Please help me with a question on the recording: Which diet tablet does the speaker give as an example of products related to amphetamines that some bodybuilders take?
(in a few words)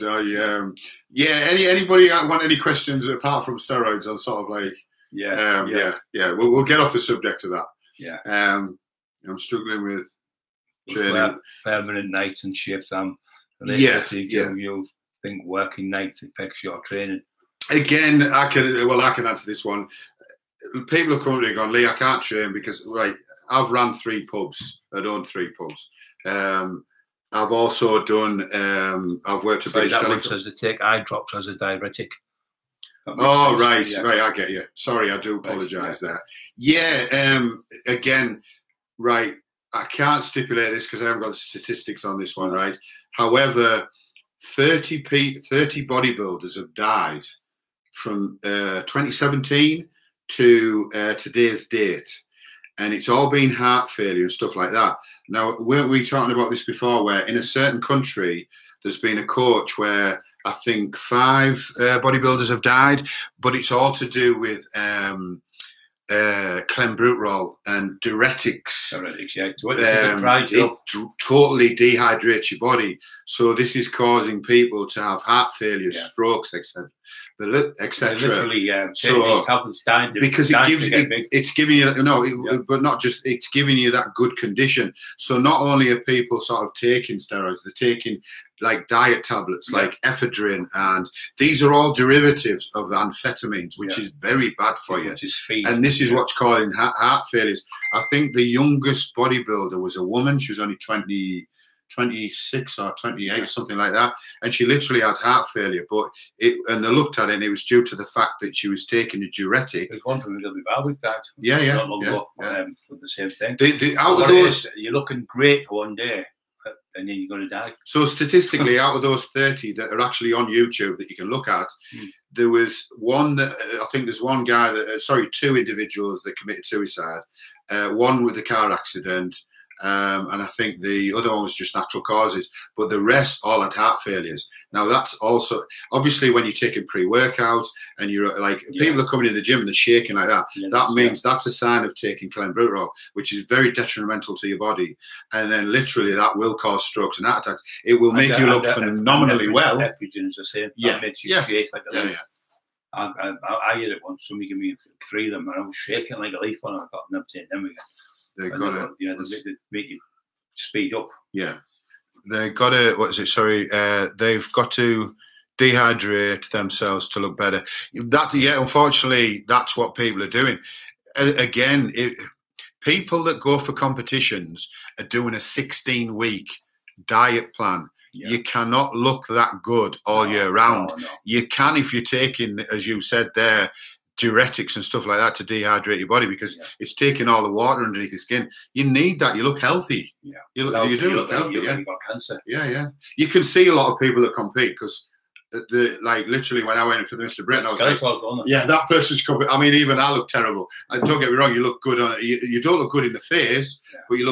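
Ephedrine.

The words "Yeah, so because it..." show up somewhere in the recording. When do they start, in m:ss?
1:18.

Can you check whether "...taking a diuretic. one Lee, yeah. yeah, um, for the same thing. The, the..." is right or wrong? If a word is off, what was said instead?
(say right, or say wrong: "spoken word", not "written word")
wrong: "Yeah", not "Lee".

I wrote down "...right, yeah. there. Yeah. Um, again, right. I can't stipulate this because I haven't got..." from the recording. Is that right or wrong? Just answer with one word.
right.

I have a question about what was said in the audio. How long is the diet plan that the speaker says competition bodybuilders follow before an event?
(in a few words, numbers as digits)
16 weeks.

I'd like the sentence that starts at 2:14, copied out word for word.
Now that's also obviously when you're taking pre-workout and you're like yeah.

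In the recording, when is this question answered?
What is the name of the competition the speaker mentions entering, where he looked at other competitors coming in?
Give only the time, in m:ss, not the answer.
3:17.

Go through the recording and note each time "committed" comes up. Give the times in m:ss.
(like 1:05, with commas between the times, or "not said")
2:06.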